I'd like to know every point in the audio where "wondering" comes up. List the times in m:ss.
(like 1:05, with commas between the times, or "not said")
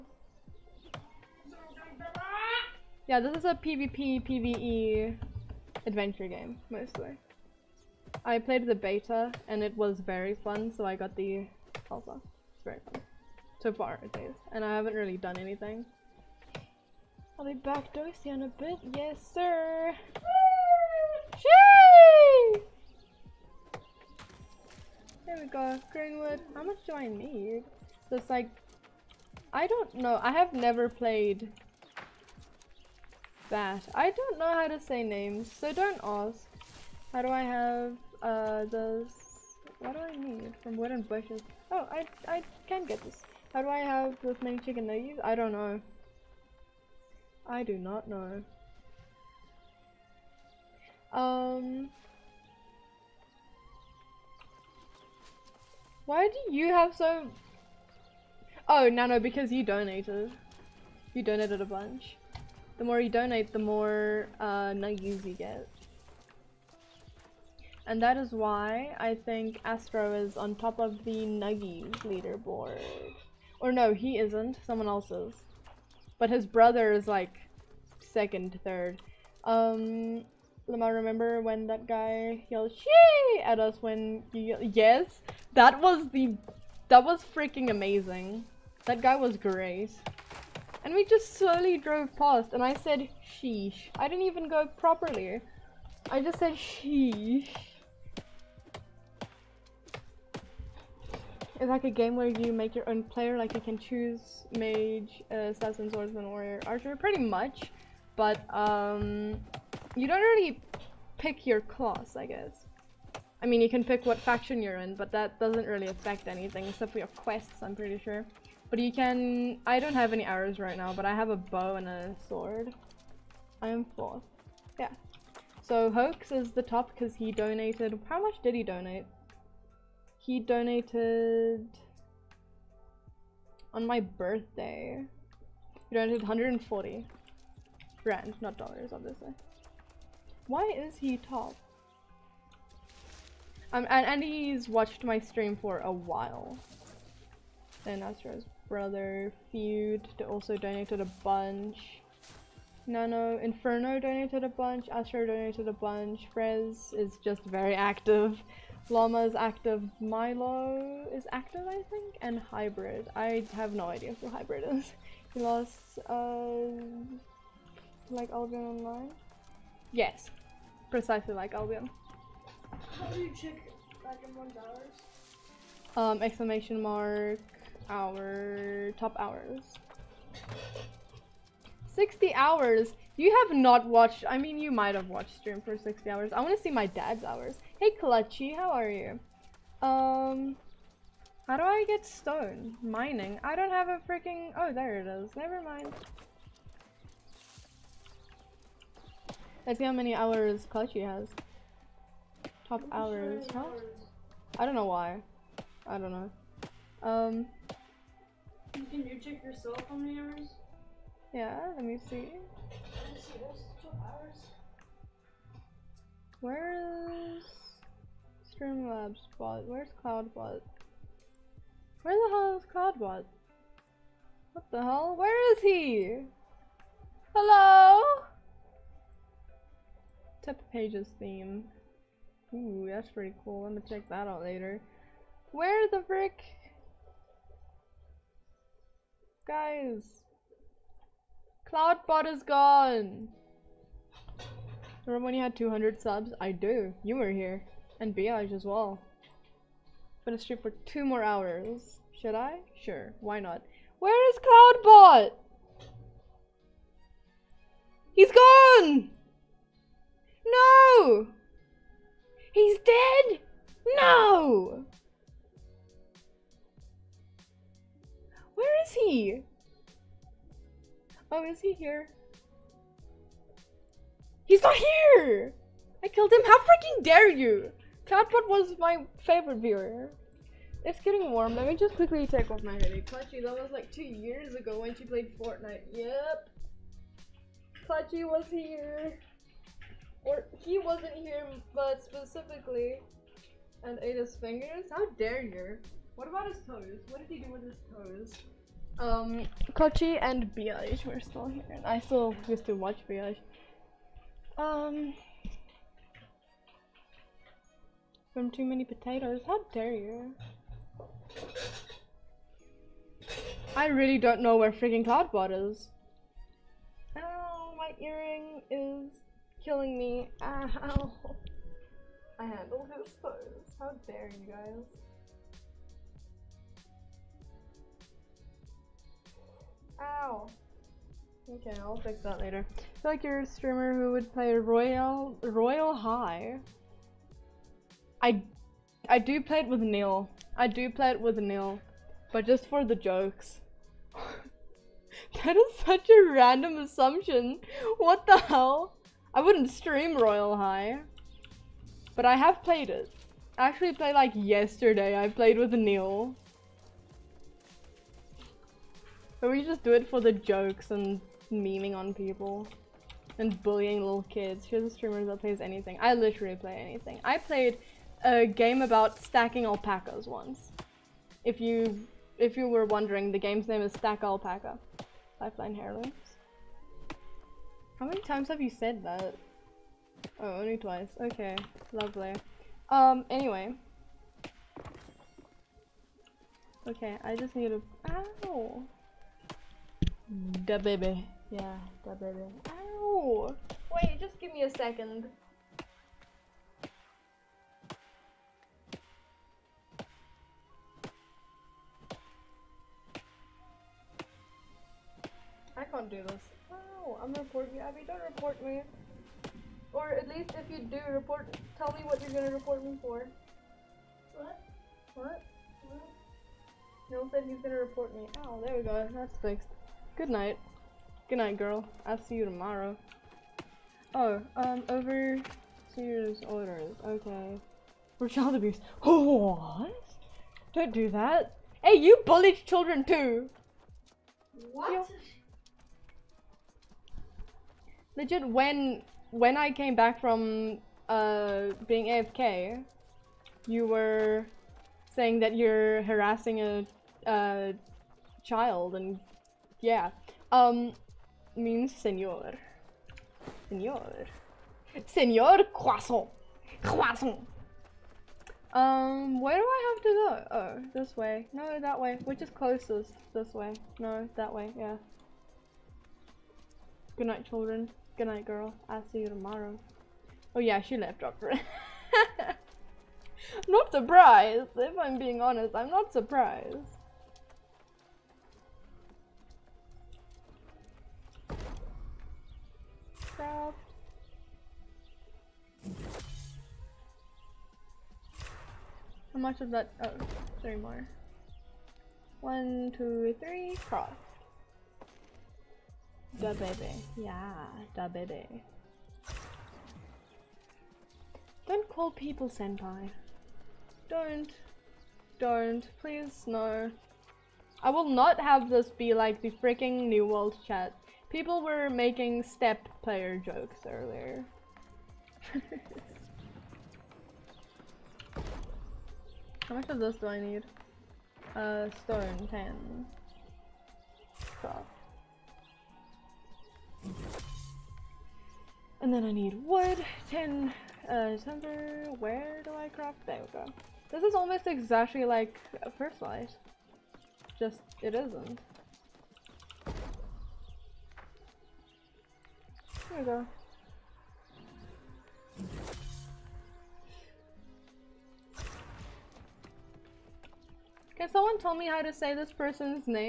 6:12.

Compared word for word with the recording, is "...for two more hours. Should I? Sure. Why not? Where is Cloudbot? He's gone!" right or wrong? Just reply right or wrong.
right.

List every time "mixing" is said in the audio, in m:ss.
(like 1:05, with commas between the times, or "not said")
not said.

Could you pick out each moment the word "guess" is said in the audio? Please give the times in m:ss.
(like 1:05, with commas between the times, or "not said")
1:52.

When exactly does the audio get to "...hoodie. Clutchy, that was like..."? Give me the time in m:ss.
4:42.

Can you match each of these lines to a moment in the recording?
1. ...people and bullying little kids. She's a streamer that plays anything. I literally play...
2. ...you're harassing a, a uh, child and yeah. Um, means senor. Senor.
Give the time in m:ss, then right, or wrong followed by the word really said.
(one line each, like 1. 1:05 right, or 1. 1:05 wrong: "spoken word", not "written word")
1. 6:02 right
2. 7:25 right.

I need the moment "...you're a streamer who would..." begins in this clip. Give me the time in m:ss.
5:33.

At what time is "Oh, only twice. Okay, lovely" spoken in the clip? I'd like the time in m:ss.
6:20.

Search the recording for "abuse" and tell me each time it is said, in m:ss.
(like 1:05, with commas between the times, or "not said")
7:08.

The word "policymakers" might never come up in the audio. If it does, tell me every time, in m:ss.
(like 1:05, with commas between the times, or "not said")
not said.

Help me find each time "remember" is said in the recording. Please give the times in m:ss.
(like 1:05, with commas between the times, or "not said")
1:20, 4:05.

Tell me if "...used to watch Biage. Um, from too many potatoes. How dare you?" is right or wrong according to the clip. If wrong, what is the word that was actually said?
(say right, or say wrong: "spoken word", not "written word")
right.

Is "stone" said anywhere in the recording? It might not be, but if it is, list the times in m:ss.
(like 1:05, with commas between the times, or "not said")
3:12, 8:42.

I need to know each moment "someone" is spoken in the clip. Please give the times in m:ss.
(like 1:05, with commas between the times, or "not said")
1:14, 9:11.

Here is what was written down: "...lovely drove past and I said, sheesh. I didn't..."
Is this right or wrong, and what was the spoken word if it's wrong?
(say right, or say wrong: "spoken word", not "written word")
wrong: "slowly", not "lovely".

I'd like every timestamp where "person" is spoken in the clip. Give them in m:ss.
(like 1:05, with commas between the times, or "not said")
9:12.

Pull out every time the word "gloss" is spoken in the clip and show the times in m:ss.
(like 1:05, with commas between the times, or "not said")
not said.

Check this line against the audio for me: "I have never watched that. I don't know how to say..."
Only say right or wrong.
wrong.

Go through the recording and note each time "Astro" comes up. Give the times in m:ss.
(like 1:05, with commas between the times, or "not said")
1:09, 2:28, 2:34.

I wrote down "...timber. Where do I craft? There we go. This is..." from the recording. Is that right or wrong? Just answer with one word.
right.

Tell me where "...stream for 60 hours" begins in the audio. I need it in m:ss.
3:05.